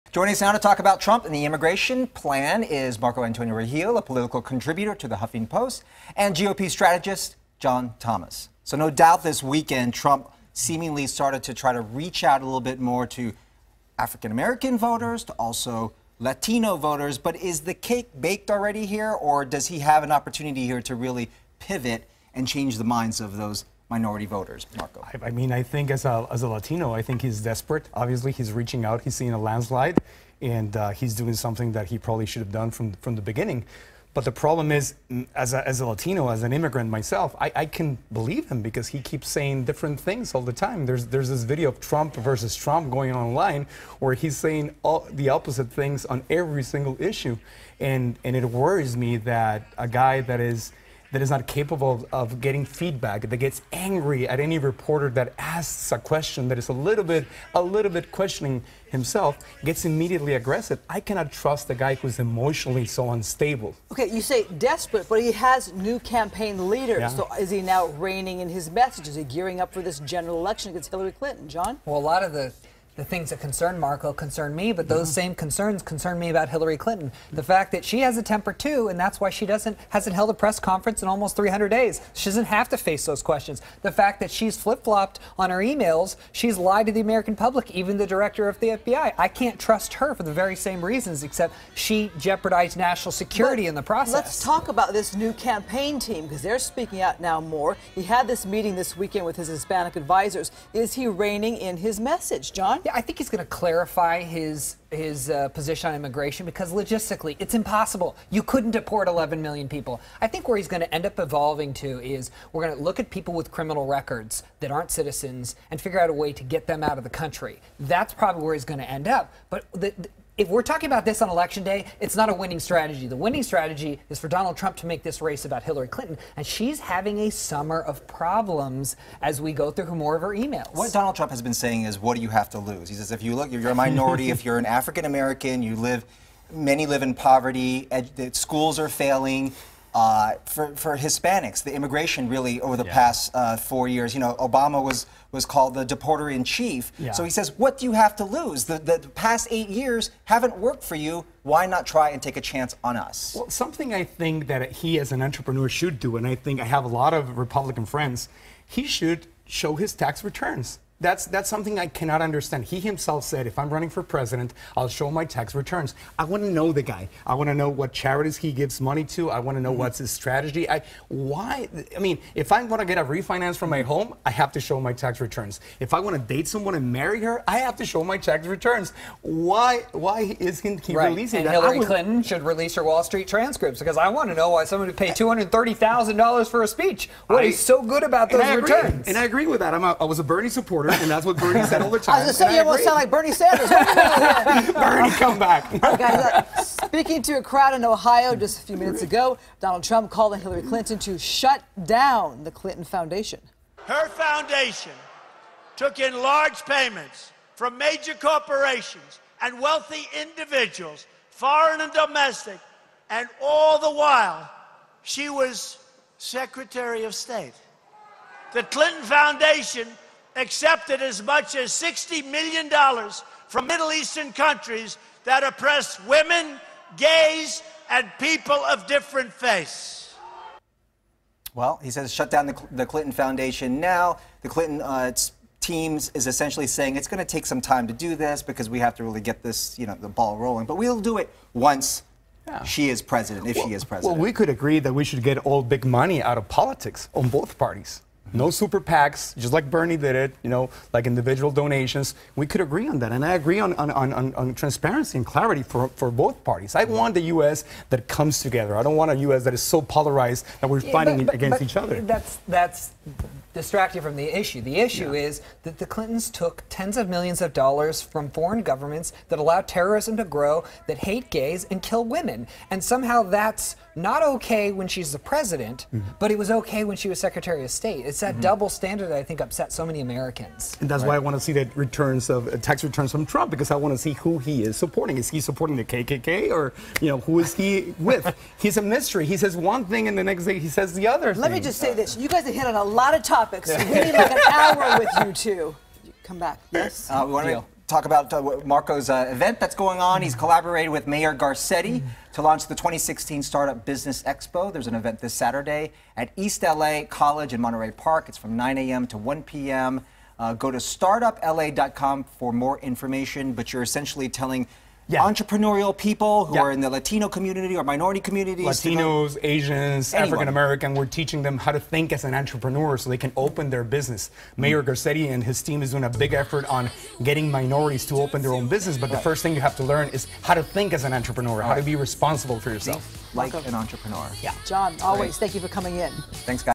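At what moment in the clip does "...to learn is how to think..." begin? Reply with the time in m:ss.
5:29.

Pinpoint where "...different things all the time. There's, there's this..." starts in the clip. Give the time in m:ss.
0:39.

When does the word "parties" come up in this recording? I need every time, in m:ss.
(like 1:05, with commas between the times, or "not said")
4:07, 4:16.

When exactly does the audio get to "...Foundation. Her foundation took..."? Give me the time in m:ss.
3:22.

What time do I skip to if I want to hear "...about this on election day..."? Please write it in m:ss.
2:00.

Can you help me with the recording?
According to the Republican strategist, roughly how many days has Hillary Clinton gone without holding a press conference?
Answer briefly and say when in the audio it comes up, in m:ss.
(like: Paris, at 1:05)
300, at 1:21.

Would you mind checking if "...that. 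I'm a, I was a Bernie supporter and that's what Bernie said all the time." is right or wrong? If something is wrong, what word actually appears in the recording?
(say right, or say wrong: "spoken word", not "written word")
right.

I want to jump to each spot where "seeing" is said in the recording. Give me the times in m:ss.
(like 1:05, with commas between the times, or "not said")
0:29.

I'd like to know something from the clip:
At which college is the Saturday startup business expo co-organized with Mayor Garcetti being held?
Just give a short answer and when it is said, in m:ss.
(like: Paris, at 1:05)
East LA College, at 5:06.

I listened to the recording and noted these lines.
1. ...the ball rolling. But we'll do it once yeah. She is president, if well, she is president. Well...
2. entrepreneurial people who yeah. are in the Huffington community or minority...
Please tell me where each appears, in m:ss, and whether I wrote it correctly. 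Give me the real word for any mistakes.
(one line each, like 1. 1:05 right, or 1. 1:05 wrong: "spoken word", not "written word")
1. 3:59 right
2. 5:15 wrong: "Latino", not "Huffington".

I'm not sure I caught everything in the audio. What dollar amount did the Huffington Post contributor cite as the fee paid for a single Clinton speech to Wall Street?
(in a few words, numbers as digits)
$230,000.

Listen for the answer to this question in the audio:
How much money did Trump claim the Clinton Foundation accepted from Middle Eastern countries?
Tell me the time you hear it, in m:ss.
3:41.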